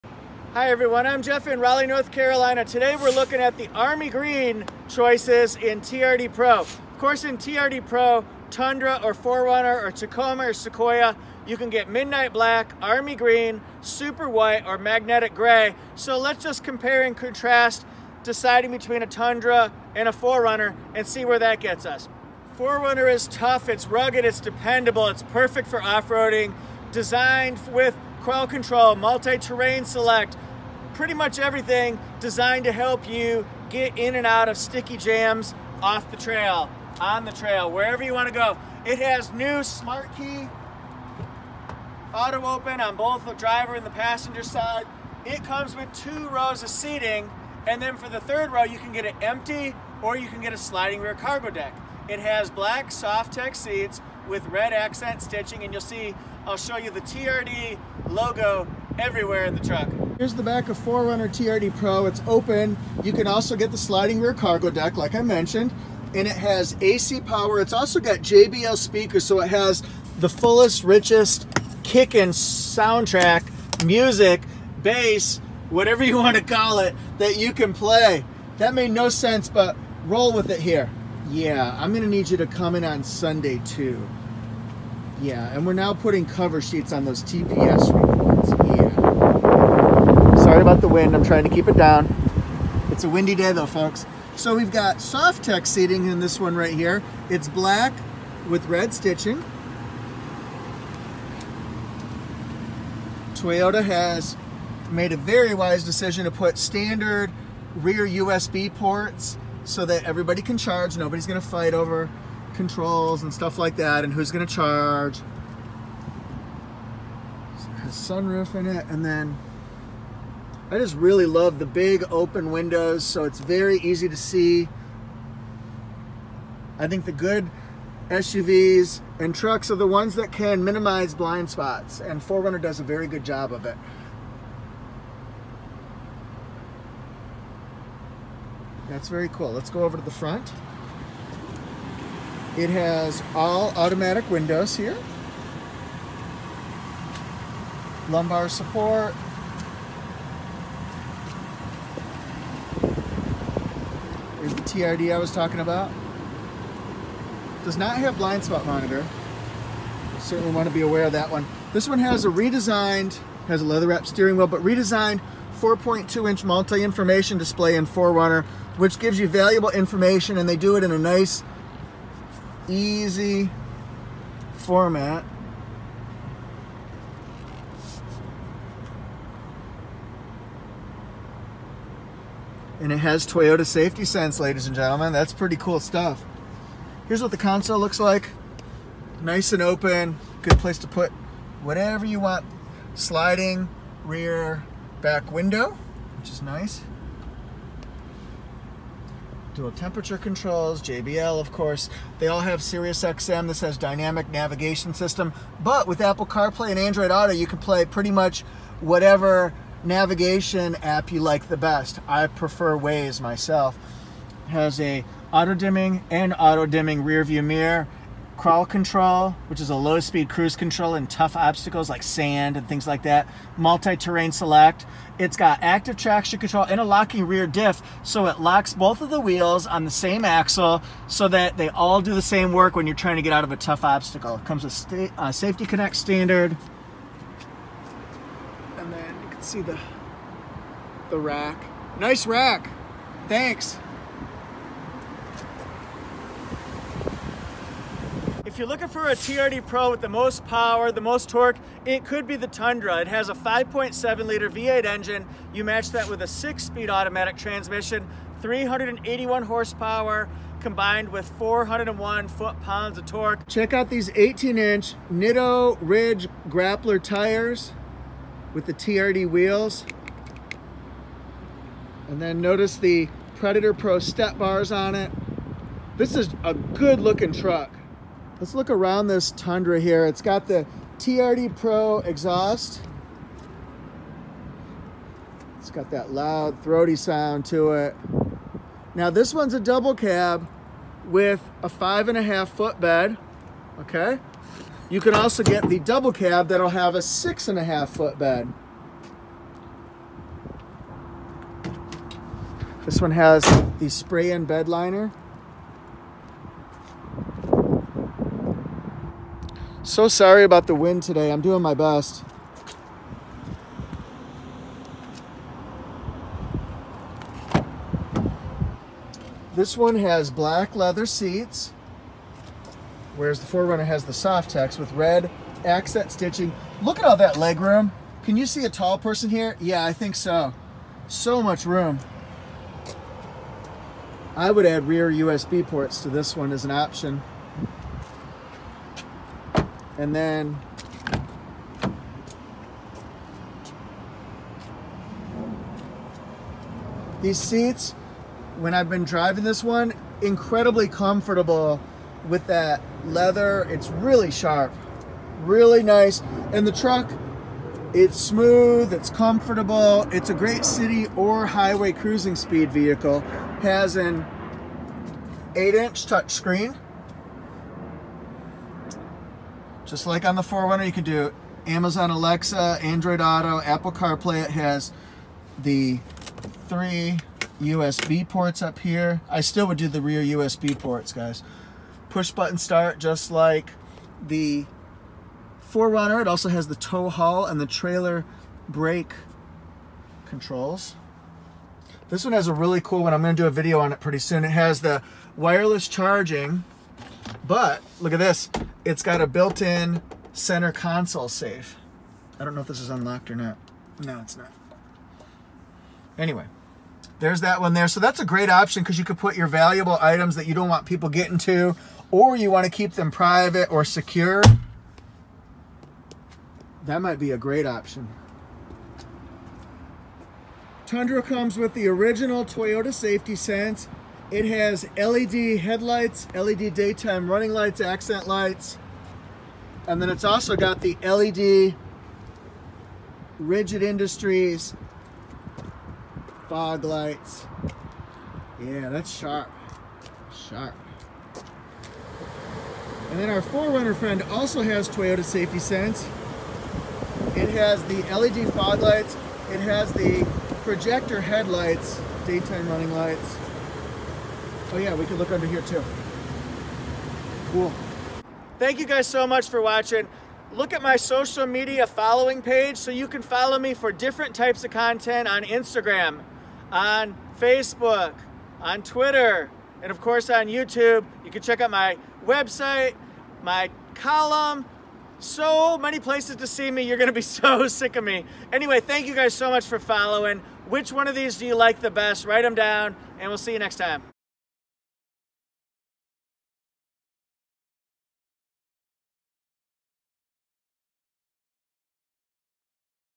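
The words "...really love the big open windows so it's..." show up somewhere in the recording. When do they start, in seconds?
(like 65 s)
120 s.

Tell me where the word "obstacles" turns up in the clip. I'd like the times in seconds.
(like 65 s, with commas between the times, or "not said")
221 s, 233 s.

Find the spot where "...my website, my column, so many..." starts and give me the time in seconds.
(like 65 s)
471 s.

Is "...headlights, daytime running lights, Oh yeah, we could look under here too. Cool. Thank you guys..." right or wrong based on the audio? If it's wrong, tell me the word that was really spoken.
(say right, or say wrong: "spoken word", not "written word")
right.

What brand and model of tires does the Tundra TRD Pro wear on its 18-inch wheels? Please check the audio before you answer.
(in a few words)
Nitto Ridge Grappler.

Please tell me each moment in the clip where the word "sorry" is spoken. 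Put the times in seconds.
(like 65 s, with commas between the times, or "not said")
90 s, 310 s.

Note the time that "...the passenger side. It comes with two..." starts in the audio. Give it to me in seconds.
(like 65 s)
43 s.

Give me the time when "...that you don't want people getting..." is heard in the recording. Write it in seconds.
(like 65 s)
410 s.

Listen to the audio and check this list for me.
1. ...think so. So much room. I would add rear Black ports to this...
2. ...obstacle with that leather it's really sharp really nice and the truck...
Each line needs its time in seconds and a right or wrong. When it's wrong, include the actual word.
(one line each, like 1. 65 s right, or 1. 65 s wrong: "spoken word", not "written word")
1. 329 s wrong: "USB", not "Black"
2. 350 s wrong: "comfortable", not "obstacle".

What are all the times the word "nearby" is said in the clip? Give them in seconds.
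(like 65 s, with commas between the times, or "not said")
not said.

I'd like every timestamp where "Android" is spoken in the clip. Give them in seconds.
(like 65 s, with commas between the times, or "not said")
206 s, 372 s.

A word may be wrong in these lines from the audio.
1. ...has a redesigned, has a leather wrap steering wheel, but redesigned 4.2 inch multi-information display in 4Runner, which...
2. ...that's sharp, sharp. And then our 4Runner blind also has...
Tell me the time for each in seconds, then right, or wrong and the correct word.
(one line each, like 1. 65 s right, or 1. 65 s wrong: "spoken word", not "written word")
1. 161 s right
2. 438 s wrong: "friend", not "blind".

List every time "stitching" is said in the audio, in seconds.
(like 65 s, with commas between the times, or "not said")
55 s, 98 s, 326 s.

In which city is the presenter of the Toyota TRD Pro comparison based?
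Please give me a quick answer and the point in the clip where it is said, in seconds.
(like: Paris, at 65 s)
Raleigh, at 1 s.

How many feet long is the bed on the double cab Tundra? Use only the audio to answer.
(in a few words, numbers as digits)
5.5.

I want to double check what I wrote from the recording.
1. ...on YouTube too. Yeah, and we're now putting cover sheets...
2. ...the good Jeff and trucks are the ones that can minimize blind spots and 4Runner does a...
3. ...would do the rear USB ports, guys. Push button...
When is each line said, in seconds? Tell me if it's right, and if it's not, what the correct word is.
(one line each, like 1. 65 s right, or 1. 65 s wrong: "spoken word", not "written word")
1. 82 s wrong: "Sunday", not "YouTube"
2. 127 s wrong: "SUVs", not "Jeff"
3. 379 s right.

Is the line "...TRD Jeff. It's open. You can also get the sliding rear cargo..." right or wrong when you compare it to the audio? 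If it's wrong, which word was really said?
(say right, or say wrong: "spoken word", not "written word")
wrong: "Pro", not "Jeff".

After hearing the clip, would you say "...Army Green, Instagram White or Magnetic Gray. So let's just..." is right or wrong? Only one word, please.
wrong.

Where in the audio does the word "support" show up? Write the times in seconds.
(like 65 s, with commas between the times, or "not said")
148 s.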